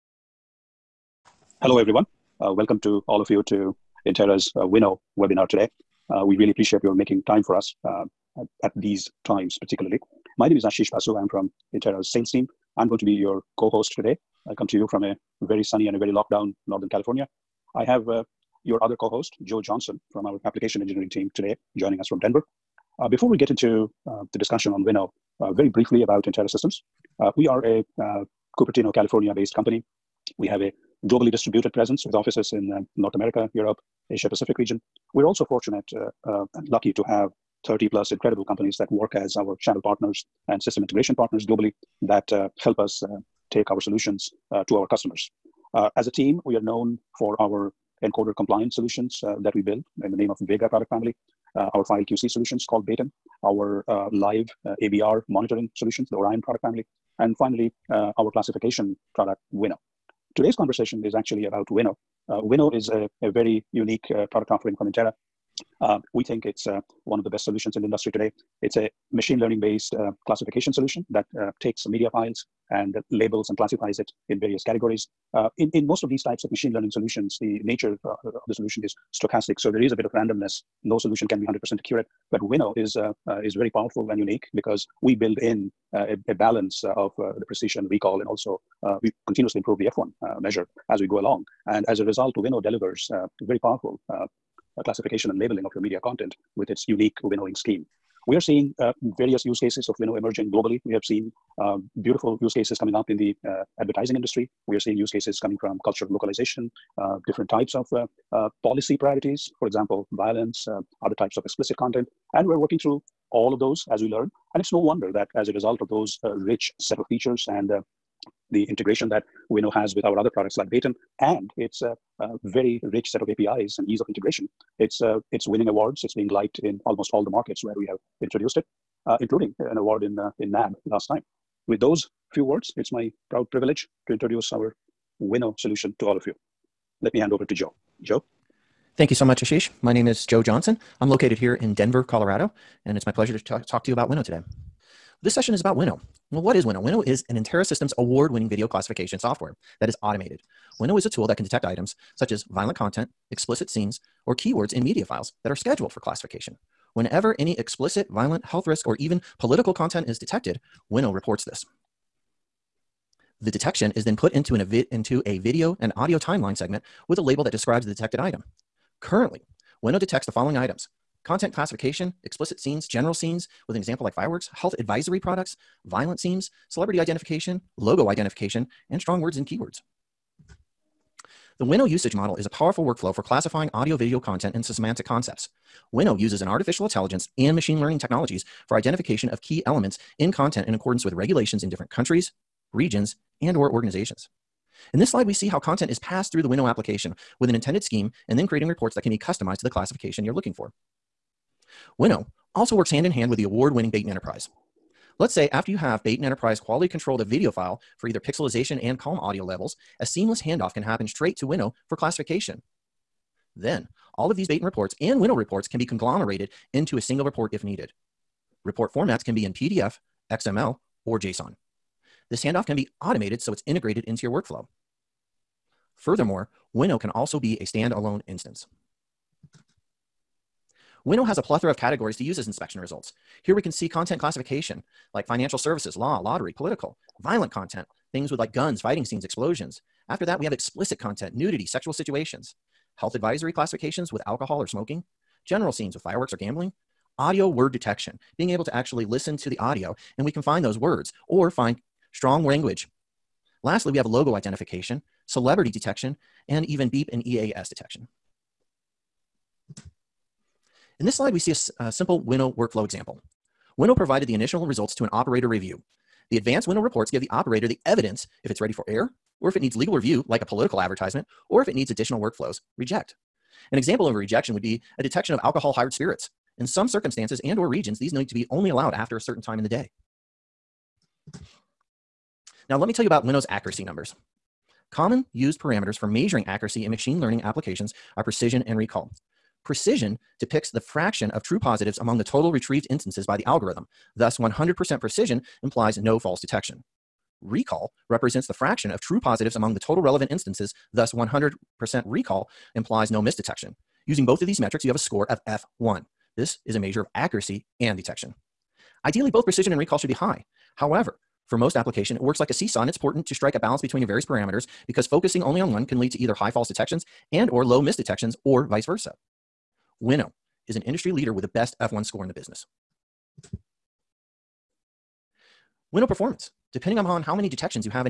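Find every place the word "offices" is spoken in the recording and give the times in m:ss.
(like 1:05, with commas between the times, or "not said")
0:32.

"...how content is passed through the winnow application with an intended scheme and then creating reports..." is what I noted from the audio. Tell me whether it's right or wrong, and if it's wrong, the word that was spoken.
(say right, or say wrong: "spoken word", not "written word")
right.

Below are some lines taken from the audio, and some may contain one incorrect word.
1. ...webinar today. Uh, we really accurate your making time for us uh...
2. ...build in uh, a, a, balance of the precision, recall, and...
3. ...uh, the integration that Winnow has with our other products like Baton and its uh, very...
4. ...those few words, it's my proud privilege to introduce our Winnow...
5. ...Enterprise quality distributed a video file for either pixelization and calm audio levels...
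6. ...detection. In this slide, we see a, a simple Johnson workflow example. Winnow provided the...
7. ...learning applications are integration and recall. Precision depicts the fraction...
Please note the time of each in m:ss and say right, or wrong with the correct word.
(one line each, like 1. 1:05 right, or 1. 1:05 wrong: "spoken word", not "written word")
1. 0:05 wrong: "appreciate", not "accurate"
2. 1:25 right
3. 1:57 right
4. 2:11 right
5. 3:26 wrong: "controlled", not "distributed"
6. 4:17 wrong: "Winnow", not "Johnson"
7. 4:47 wrong: "precision", not "integration".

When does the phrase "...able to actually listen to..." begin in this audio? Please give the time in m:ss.
4:08.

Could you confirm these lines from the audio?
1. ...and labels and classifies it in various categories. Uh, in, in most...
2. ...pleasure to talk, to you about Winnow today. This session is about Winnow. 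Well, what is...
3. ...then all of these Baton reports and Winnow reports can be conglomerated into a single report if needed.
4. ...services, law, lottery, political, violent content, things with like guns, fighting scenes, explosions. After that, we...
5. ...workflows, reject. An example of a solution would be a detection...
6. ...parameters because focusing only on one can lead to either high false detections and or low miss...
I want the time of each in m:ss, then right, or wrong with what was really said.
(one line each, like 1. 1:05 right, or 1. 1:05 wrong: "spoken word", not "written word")
1. 1:12 right
2. 2:23 right
3. 3:33 right
4. 3:55 right
5. 4:32 wrong: "rejection", not "solution"
6. 5:14 right.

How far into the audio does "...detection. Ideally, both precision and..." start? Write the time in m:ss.
5:07.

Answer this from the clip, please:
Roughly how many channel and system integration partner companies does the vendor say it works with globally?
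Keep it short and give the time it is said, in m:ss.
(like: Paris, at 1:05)
30 plus, at 0:37.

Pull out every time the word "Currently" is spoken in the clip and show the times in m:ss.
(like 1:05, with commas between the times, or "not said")
2:49.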